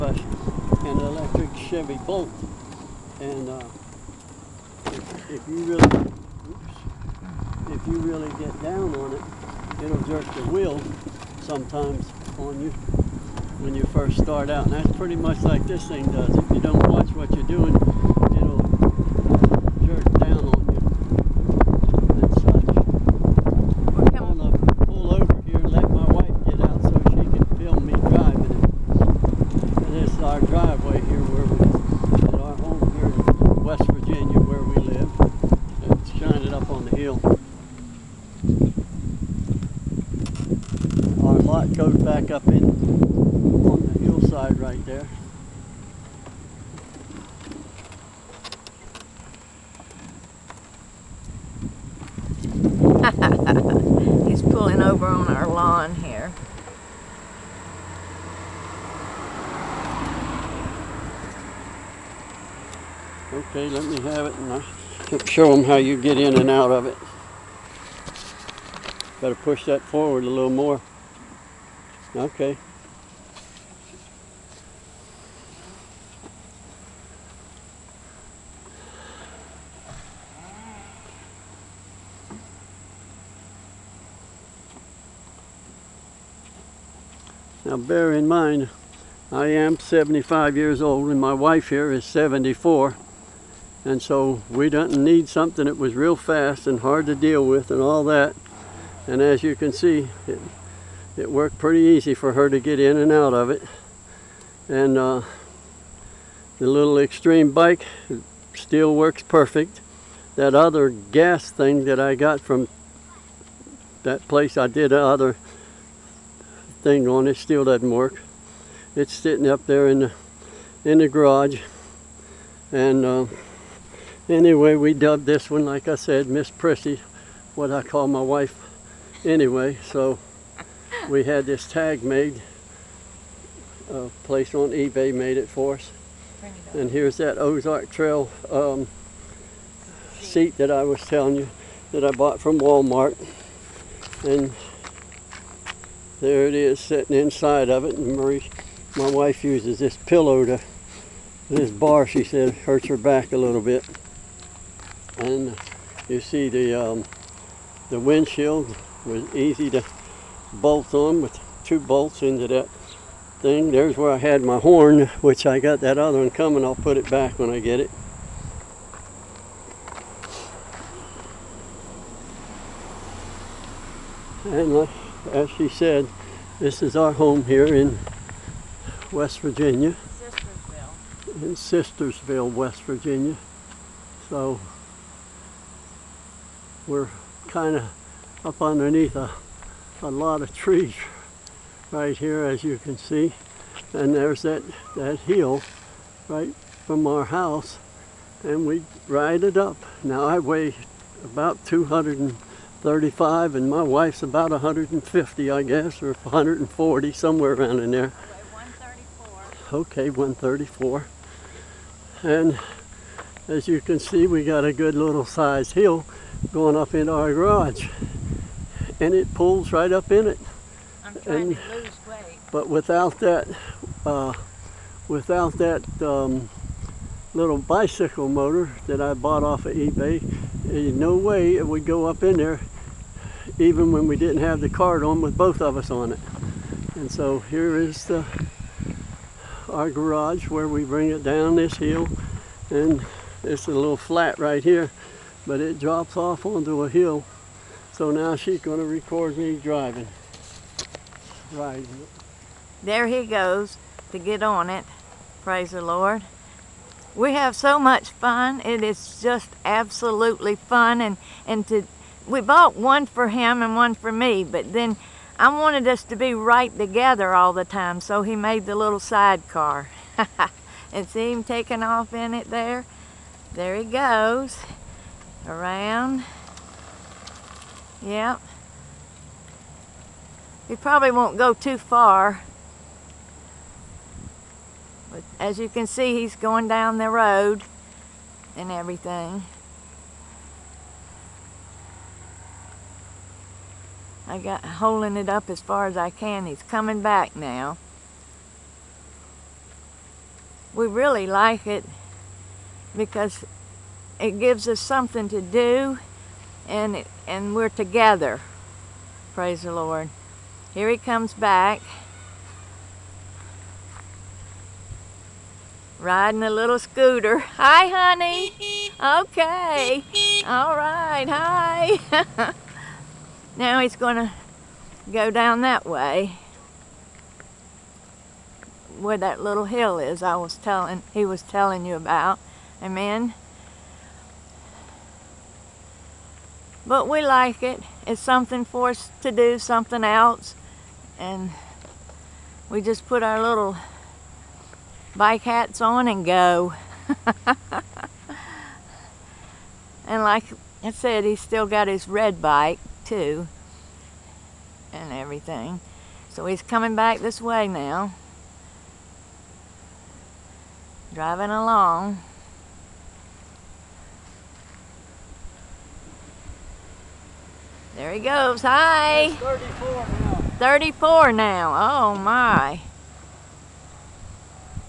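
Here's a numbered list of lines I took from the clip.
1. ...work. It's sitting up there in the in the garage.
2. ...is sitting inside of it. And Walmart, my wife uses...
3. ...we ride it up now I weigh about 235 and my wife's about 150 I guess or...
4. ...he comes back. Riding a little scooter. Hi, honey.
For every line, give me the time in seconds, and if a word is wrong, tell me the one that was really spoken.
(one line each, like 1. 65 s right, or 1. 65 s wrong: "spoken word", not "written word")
1. 117 s right
2. 146 s wrong: "Marie", not "Walmart"
3. 198 s right
4. 310 s right.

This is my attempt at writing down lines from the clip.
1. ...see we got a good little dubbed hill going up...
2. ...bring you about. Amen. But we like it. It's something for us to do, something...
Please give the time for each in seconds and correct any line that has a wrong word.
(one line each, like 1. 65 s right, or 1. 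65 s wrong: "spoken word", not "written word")
1. 213 s wrong: "sized", not "dubbed"
2. 331 s wrong: "telling", not "bring".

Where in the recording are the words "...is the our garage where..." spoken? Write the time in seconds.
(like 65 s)
237 s.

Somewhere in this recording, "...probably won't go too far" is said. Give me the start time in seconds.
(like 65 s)
280 s.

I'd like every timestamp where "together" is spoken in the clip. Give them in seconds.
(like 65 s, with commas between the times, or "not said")
266 s, 307 s.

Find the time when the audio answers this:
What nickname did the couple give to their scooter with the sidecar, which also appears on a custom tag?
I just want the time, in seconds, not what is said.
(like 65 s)
126 s.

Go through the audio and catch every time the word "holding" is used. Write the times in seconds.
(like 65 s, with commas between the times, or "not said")
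294 s.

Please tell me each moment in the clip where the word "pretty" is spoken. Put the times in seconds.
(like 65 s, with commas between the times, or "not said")
14 s, 101 s.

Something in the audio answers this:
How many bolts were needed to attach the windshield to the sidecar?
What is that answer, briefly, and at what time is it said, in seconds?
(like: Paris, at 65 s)
2, at 161 s.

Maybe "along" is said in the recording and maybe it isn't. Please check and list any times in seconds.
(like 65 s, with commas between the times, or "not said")
361 s.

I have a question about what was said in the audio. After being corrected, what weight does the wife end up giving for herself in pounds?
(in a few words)
134.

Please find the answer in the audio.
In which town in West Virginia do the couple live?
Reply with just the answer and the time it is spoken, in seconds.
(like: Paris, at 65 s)
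Sistersville, at 181 s.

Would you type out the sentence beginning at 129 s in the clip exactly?
So we had this tag made, uh, placed on eBay, made it for us.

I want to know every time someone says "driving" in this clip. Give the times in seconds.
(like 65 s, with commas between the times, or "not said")
249 s, 361 s.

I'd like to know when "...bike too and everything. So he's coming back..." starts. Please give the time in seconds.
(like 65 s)
352 s.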